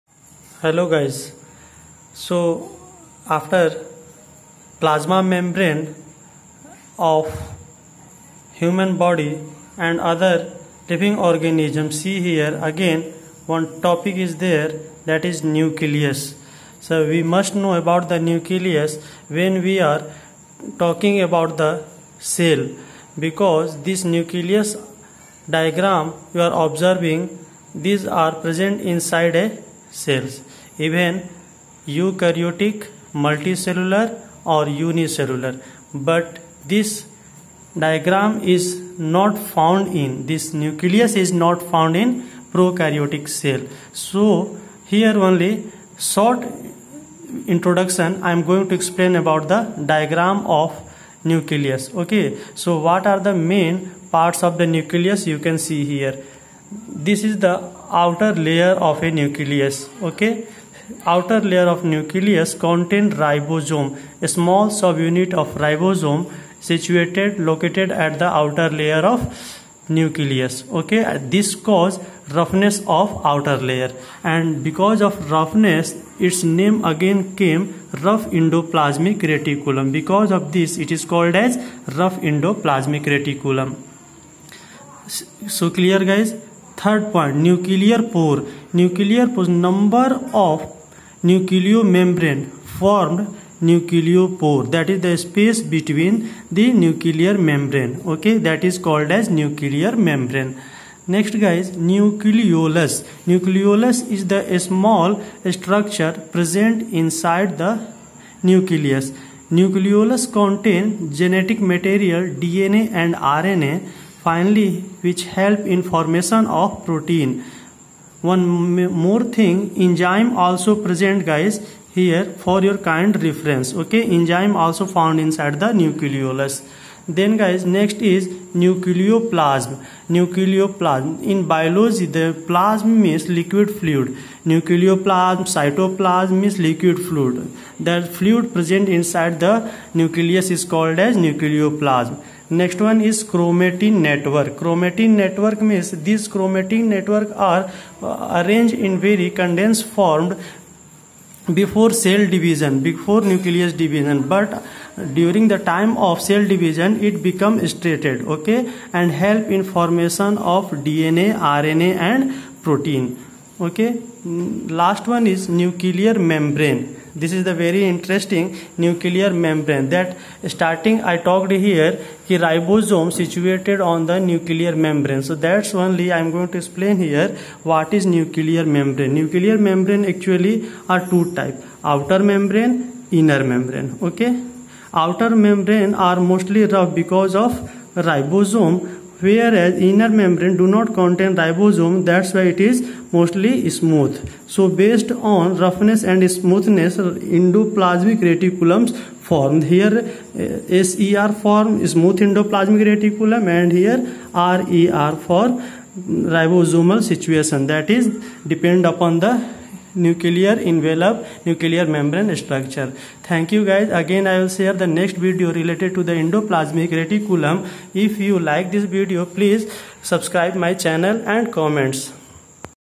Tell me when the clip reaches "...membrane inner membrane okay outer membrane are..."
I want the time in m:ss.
3:02.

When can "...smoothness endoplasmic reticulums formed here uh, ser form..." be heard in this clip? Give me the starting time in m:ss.
3:16.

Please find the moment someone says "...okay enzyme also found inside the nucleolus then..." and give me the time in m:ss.
2:03.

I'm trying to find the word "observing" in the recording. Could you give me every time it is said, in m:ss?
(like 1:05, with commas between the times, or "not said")
0:26.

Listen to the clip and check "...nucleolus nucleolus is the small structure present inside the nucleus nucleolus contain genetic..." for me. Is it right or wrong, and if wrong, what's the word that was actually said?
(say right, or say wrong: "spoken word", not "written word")
right.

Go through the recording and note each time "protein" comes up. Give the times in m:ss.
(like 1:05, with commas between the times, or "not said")
1:56, 2:42.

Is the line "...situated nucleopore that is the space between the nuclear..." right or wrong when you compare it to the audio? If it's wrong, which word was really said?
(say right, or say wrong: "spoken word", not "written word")
wrong: "formed", not "situated".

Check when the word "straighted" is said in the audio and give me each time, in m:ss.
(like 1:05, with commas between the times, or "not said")
2:37.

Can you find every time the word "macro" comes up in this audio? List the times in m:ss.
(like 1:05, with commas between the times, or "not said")
not said.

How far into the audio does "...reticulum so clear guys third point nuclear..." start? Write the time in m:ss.
1:23.